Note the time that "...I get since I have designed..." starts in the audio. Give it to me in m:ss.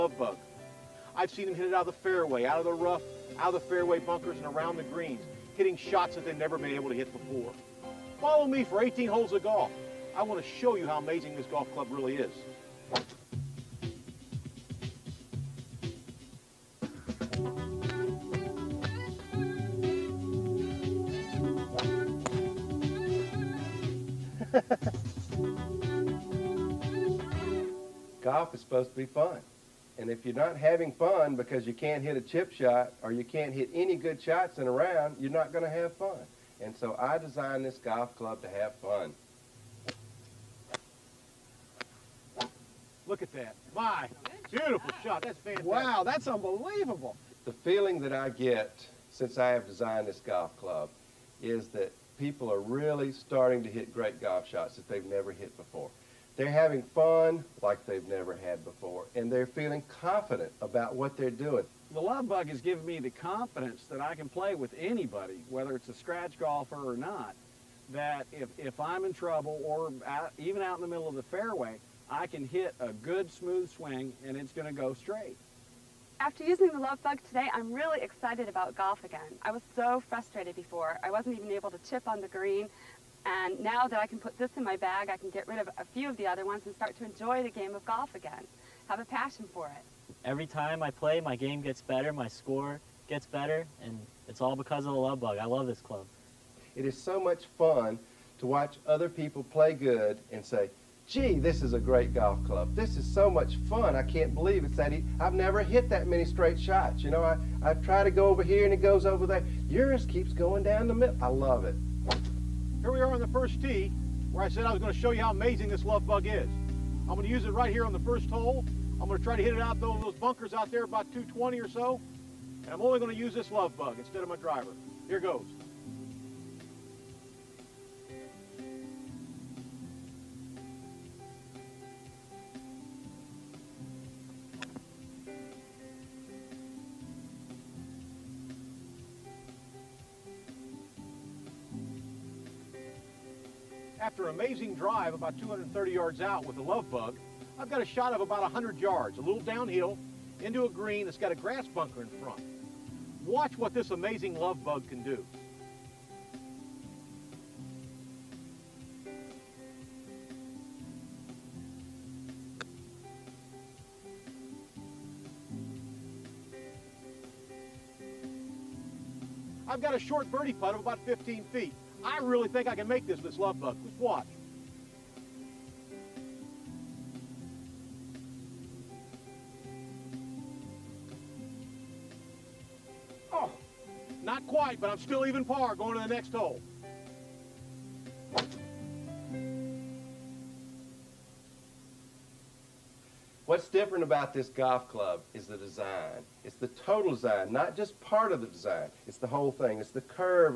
0:48.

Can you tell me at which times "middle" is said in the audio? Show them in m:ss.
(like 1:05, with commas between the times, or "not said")
1:10, 1:50.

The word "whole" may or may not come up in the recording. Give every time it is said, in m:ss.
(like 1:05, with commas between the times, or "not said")
3:19.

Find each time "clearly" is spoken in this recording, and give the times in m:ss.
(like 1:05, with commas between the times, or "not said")
not said.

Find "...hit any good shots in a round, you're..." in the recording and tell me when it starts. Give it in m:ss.
0:33.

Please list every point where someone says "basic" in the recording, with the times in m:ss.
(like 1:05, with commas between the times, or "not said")
not said.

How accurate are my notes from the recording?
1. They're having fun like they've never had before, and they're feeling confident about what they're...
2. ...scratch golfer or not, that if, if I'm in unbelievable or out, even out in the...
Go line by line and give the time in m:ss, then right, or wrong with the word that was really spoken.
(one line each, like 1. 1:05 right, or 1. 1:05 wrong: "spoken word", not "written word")
1. 0:56 right
2. 1:05 wrong: "trouble", not "unbelievable".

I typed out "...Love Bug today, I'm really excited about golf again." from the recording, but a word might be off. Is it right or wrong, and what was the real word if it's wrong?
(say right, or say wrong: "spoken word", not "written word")
right.